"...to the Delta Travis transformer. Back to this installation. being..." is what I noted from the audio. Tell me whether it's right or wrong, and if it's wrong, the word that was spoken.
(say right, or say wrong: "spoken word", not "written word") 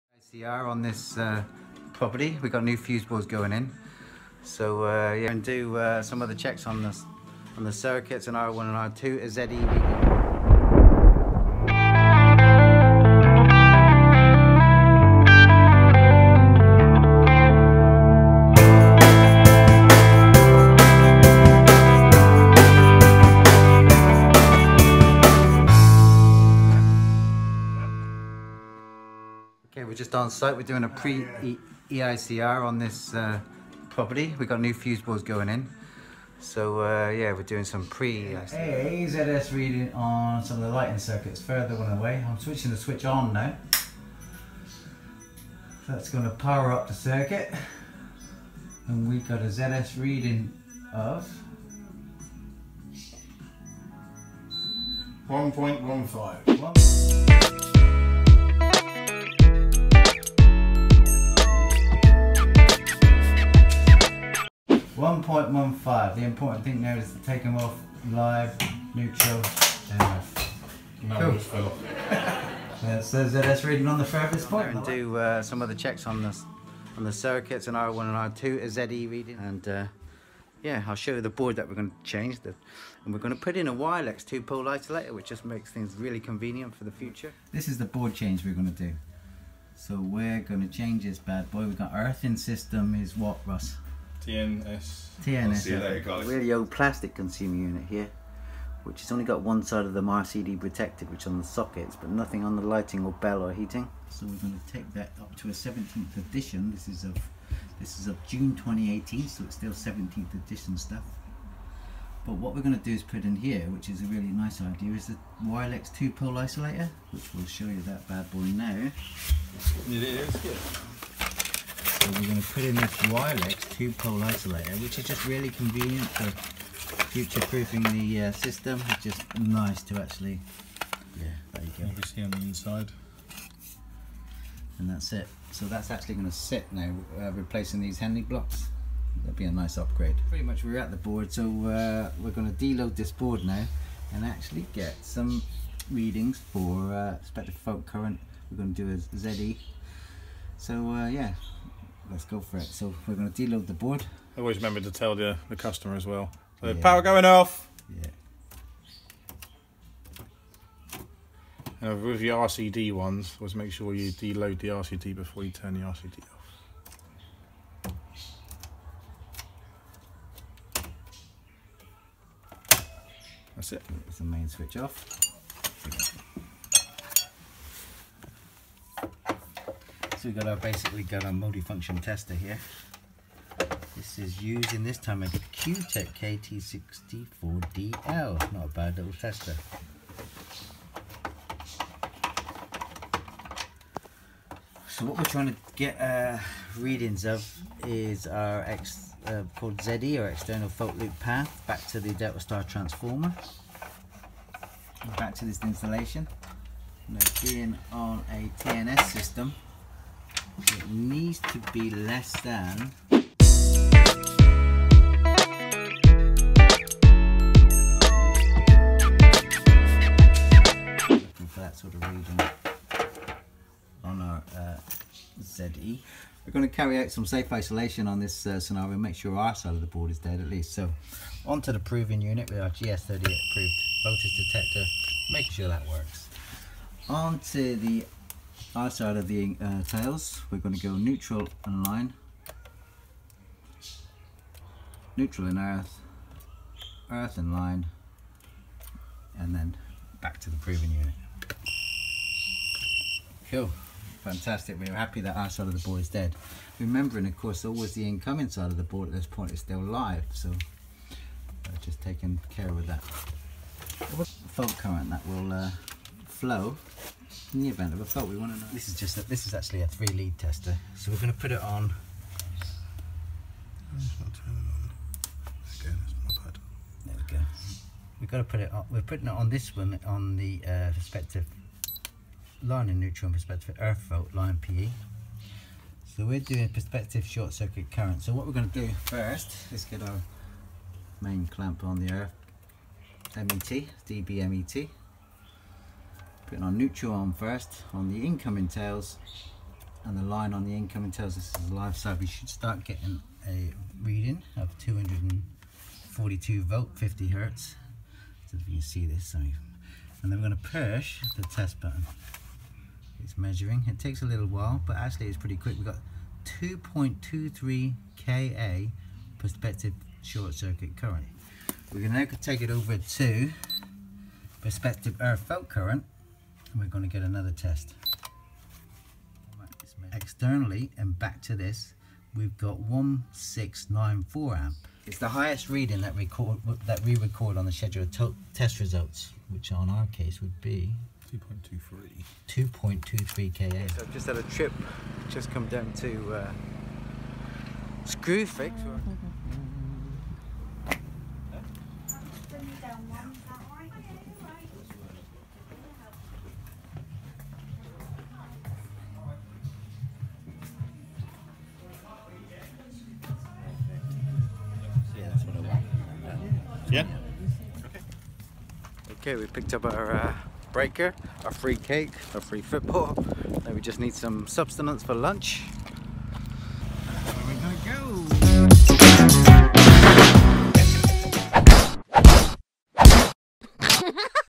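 wrong: "Star", not "Travis".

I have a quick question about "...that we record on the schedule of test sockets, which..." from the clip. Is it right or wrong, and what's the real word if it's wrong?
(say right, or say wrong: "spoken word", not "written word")
wrong: "results", not "sockets".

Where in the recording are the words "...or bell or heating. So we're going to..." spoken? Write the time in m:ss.
1:43.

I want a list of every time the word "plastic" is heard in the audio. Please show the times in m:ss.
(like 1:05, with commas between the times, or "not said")
1:36.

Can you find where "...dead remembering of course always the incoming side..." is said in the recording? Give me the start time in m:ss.
4:16.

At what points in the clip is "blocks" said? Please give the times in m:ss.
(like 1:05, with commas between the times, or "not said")
2:18.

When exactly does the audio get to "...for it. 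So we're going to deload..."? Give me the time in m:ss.
2:32.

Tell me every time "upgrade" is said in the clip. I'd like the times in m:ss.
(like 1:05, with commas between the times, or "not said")
2:19.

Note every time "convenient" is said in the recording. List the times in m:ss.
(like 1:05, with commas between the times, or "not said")
1:26, 2:05.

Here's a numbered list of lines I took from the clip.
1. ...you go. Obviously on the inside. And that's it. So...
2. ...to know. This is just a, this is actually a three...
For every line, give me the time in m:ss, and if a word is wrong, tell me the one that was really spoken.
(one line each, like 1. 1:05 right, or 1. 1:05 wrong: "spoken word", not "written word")
1. 2:11 right
2. 4:28 right.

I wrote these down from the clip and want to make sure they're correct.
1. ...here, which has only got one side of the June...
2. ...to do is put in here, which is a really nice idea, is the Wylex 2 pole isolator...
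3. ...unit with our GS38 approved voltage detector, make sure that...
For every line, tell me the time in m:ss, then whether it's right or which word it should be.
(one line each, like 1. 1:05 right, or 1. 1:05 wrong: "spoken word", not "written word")
1. 1:37 wrong: "RCD", not "June"
2. 1:52 right
3. 3:52 right.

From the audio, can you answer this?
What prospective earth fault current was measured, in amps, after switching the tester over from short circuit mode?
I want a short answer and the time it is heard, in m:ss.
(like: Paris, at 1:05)
1694 amps, at 5:32.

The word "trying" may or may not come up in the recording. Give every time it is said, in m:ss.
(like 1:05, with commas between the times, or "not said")
3:15.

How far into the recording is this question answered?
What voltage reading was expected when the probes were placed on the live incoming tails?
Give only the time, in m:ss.
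5:04.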